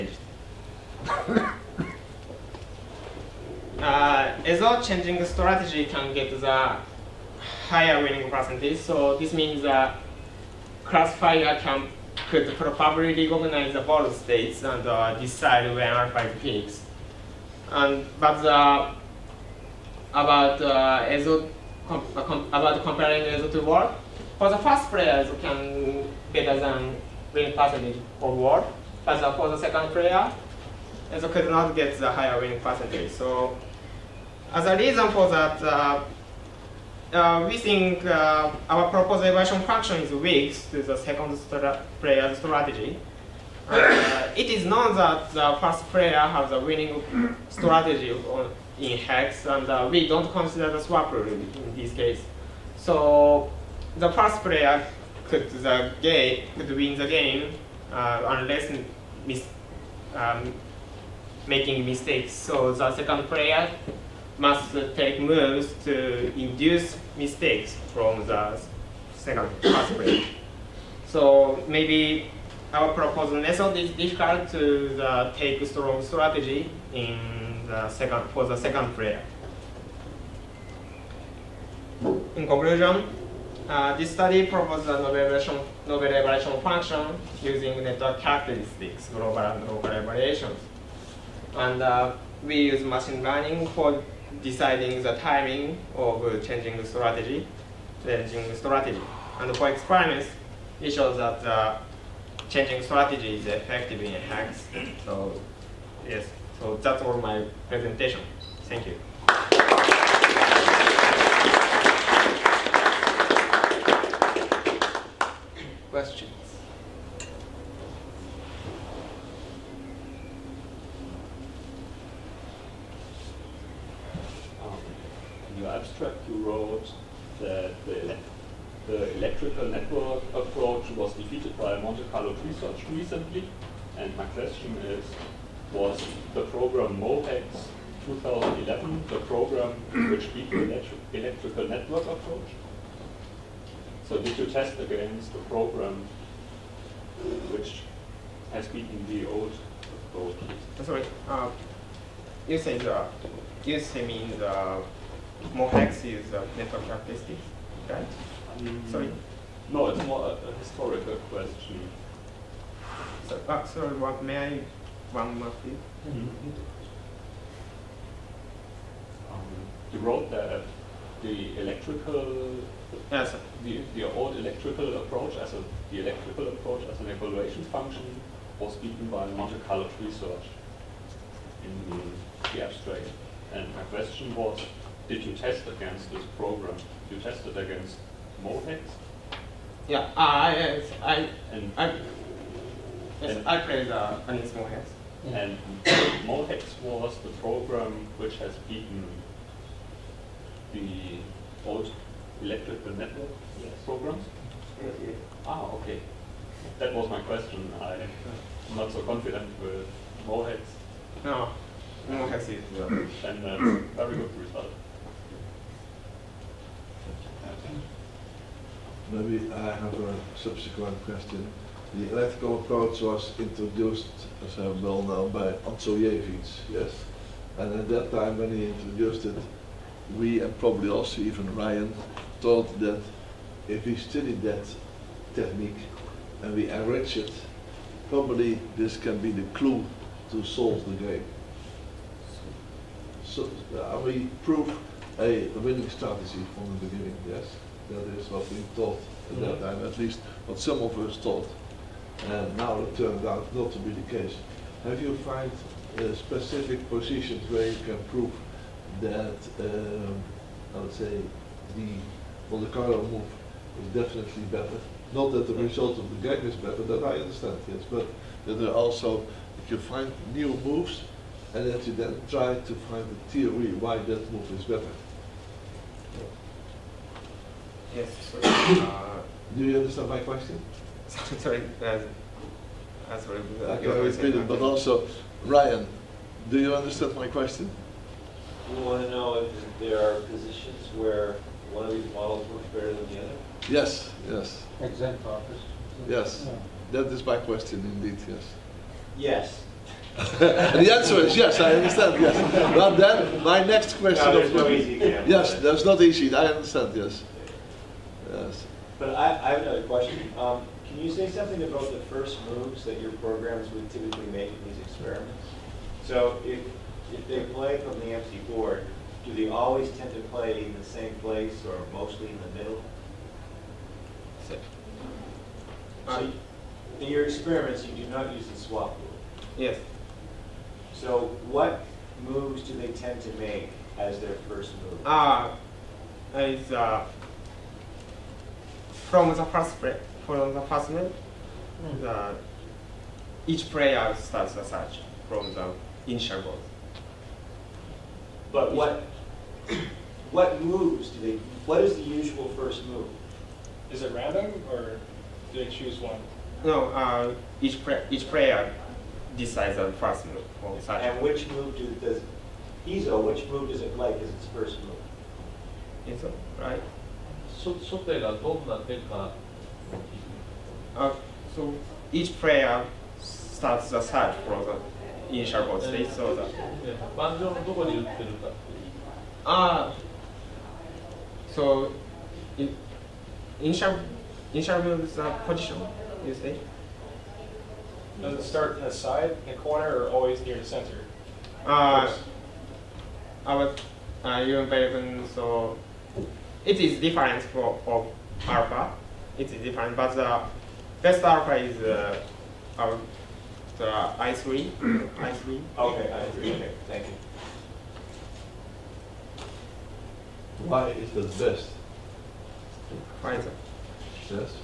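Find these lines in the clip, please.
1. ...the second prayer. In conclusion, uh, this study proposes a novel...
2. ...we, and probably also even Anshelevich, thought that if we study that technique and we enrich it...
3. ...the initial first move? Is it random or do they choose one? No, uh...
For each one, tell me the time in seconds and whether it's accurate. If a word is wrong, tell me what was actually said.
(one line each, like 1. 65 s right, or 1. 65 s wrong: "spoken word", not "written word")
1. 78 s right
2. 230 s wrong: "Ryan", not "Anshelevich"
3. 351 s wrong: "usual", not "initial".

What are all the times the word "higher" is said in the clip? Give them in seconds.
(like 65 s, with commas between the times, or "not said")
7 s, 32 s.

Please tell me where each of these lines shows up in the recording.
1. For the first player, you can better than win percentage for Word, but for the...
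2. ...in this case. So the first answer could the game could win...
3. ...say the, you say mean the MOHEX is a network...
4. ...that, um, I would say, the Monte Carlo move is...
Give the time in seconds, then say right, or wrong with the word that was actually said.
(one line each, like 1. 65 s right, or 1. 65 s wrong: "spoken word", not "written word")
1. 24 s right
2. 51 s wrong: "player", not "answer"
3. 152 s right
4. 259 s right.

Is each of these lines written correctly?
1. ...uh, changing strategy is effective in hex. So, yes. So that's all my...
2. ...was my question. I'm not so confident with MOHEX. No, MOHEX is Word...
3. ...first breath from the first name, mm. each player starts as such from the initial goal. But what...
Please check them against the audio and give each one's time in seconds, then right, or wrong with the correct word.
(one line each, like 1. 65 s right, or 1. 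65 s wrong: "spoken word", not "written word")
1. 101 s right
2. 206 s wrong: "And", not "Word"
3. 339 s right.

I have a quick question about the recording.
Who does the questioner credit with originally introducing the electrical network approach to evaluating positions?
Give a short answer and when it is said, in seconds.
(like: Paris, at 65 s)
Anshelevich, at 225 s.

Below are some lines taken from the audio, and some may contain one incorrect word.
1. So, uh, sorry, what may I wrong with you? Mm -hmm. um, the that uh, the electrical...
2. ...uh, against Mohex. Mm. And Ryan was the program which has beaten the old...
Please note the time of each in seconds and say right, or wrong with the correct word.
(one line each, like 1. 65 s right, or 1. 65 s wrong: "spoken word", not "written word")
1. 163 s right
2. 193 s wrong: "MOHEX", not "Ryan".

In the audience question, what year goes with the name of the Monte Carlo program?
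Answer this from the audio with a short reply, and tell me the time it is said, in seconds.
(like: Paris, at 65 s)
2011, at 136 s.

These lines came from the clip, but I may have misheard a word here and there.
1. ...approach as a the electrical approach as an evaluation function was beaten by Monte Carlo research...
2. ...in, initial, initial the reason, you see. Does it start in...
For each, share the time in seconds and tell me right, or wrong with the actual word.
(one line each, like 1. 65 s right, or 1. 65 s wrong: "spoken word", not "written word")
1. 174 s right
2. 382 s wrong: "position", not "reason".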